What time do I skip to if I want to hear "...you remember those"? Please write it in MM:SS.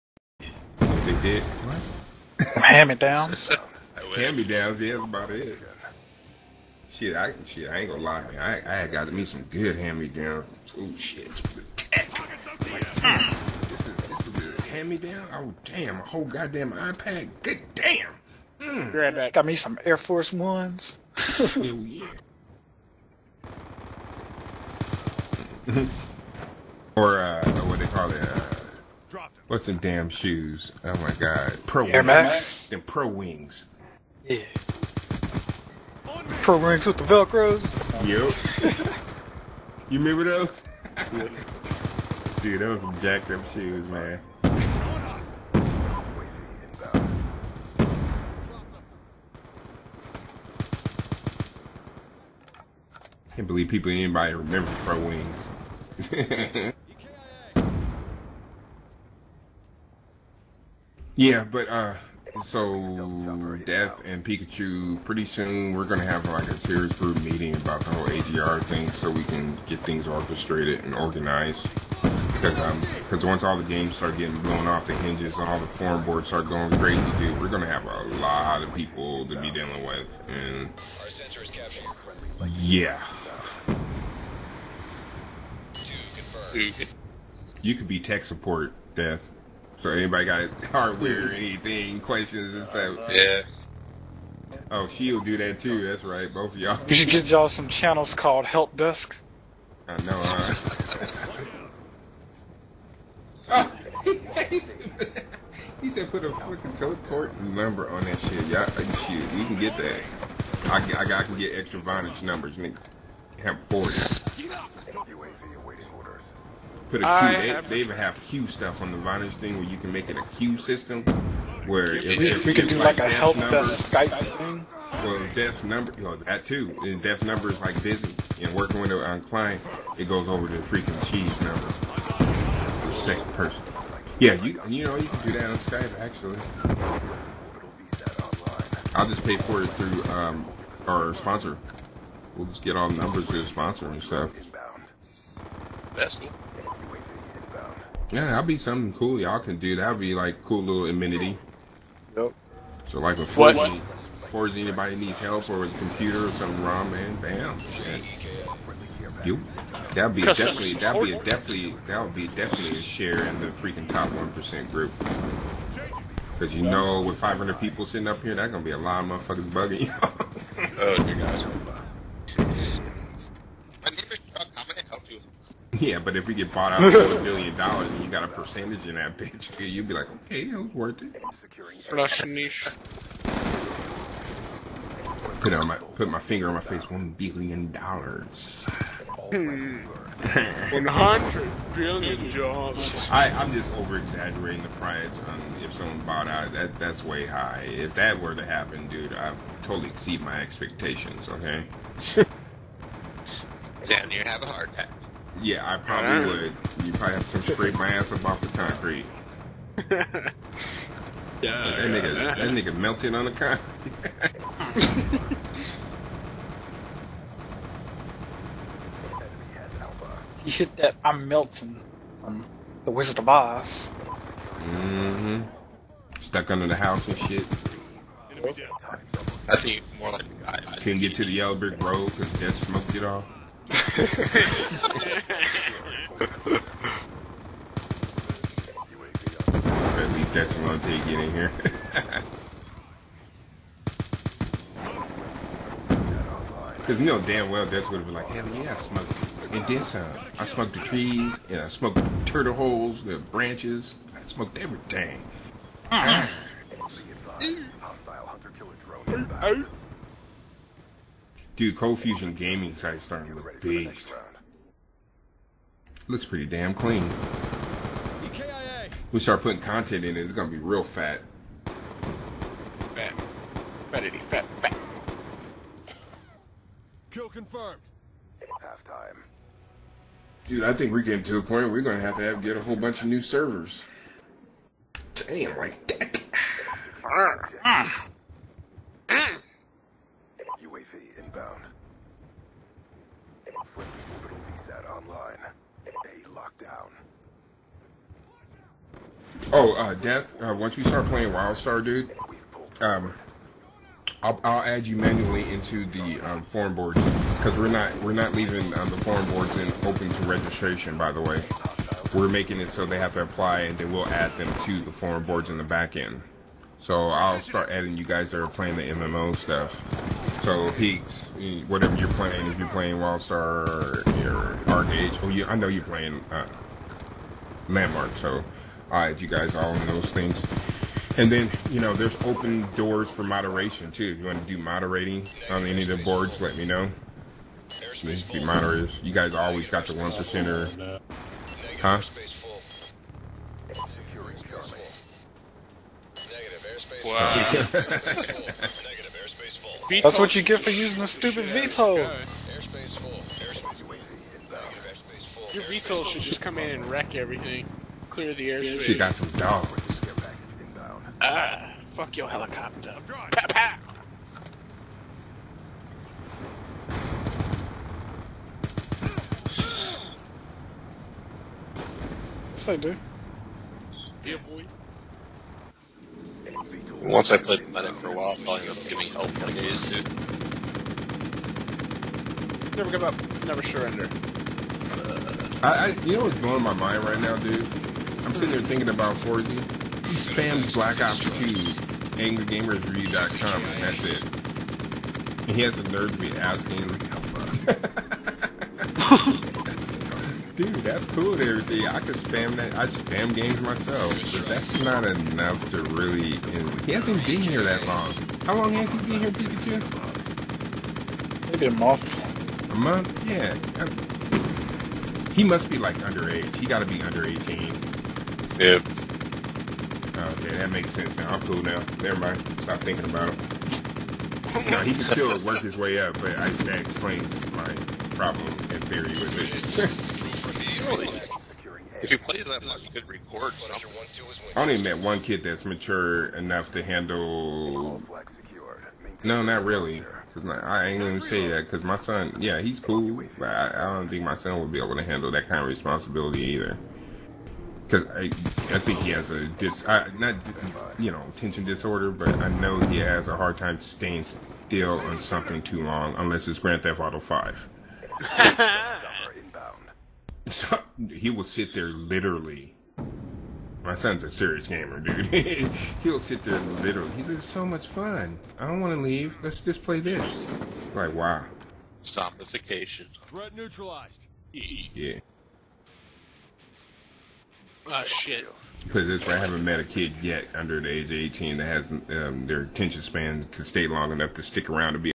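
00:39.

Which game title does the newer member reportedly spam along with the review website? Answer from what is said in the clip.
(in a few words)
Black Ops 2.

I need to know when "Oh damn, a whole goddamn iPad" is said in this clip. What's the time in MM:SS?
00:15.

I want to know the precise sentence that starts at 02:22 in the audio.
We'll just get all the numbers to the sponsor and stuff.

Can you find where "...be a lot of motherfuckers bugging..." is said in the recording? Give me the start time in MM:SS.
02:48.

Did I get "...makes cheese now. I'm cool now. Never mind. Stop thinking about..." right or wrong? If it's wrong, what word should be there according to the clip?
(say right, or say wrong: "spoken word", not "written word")
wrong: "sense", not "cheese".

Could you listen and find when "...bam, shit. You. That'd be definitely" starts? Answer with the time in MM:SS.
02:37.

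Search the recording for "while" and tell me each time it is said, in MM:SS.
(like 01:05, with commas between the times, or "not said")
06:18.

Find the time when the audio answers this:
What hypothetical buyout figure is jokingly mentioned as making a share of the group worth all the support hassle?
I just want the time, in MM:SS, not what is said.
02:56.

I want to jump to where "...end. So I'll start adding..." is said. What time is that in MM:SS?
05:15.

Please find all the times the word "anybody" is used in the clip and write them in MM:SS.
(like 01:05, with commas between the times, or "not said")
00:53, 01:29, 02:34.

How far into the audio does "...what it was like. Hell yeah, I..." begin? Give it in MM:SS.
04:07.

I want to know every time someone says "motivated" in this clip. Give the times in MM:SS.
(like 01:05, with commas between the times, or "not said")
not said.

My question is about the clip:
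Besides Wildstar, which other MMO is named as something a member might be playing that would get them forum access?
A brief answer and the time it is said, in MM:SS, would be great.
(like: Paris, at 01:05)
ArcheAge, at 05:24.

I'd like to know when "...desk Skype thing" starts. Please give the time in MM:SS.
02:03.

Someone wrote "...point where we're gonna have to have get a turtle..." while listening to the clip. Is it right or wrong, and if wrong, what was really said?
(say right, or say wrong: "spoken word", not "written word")
wrong: "whole", not "turtle".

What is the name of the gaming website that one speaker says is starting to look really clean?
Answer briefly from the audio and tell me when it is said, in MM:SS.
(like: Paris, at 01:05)
Cold Fusion Gaming, at 04:21.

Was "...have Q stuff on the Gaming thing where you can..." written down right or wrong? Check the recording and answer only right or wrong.
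wrong.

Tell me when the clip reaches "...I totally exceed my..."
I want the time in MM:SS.
03:19.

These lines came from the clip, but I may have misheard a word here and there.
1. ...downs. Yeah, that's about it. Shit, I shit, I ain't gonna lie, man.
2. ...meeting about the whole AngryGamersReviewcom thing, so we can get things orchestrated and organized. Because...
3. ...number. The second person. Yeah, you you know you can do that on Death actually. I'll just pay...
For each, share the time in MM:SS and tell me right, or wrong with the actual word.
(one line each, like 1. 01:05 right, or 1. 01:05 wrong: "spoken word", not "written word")
1. 00:04 right
2. 01:07 wrong: "AGR", not "AngryGamersReviewcom"
3. 02:11 wrong: "Skype", not "Death".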